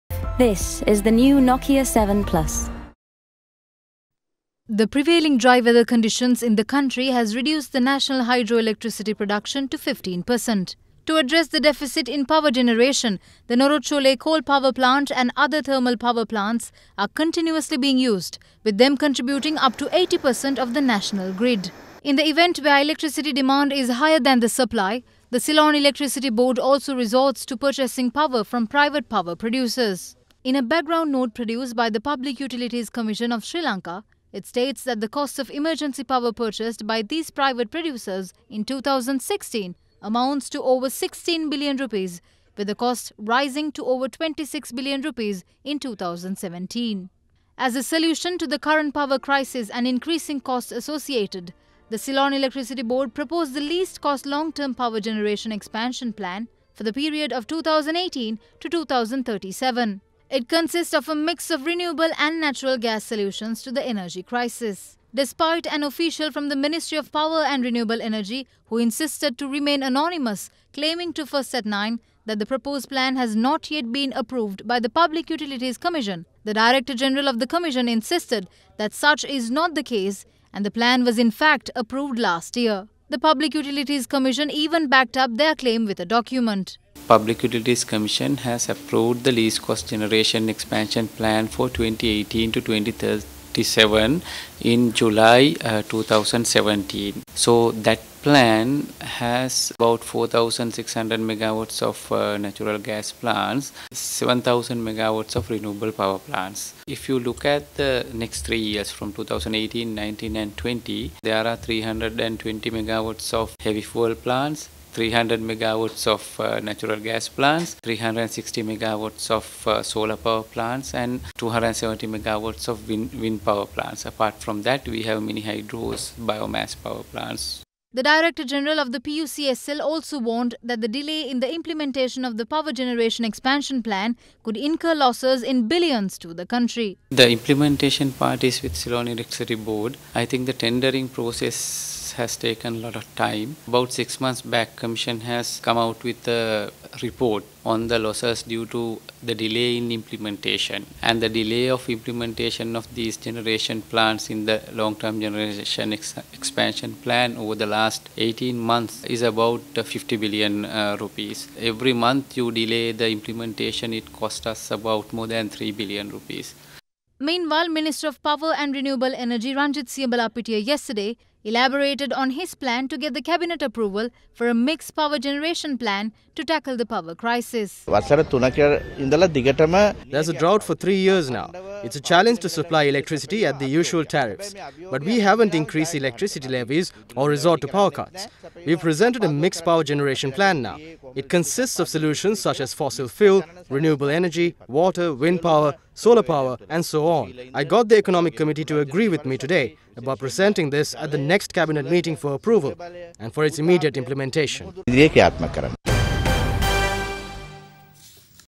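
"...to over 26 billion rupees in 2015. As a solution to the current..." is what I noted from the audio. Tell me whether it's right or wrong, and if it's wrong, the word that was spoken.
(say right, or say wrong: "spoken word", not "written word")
wrong: "2017", not "2015".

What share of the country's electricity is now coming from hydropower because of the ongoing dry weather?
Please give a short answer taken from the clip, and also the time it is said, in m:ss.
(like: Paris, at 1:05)
15%, at 0:09.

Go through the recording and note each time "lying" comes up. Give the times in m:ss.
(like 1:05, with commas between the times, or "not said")
not said.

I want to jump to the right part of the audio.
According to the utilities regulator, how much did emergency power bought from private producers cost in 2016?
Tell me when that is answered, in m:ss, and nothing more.
0:40.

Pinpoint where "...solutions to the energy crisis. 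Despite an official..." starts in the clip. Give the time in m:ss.
1:03.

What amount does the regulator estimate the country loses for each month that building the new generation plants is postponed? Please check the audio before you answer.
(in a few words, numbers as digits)
more than 3 billion rupees.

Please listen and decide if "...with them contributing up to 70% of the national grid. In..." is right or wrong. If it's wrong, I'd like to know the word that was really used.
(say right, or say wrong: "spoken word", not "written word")
wrong: "80", not "70".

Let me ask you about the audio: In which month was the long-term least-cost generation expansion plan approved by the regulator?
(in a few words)
July 2017.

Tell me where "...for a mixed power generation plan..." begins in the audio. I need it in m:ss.
2:54.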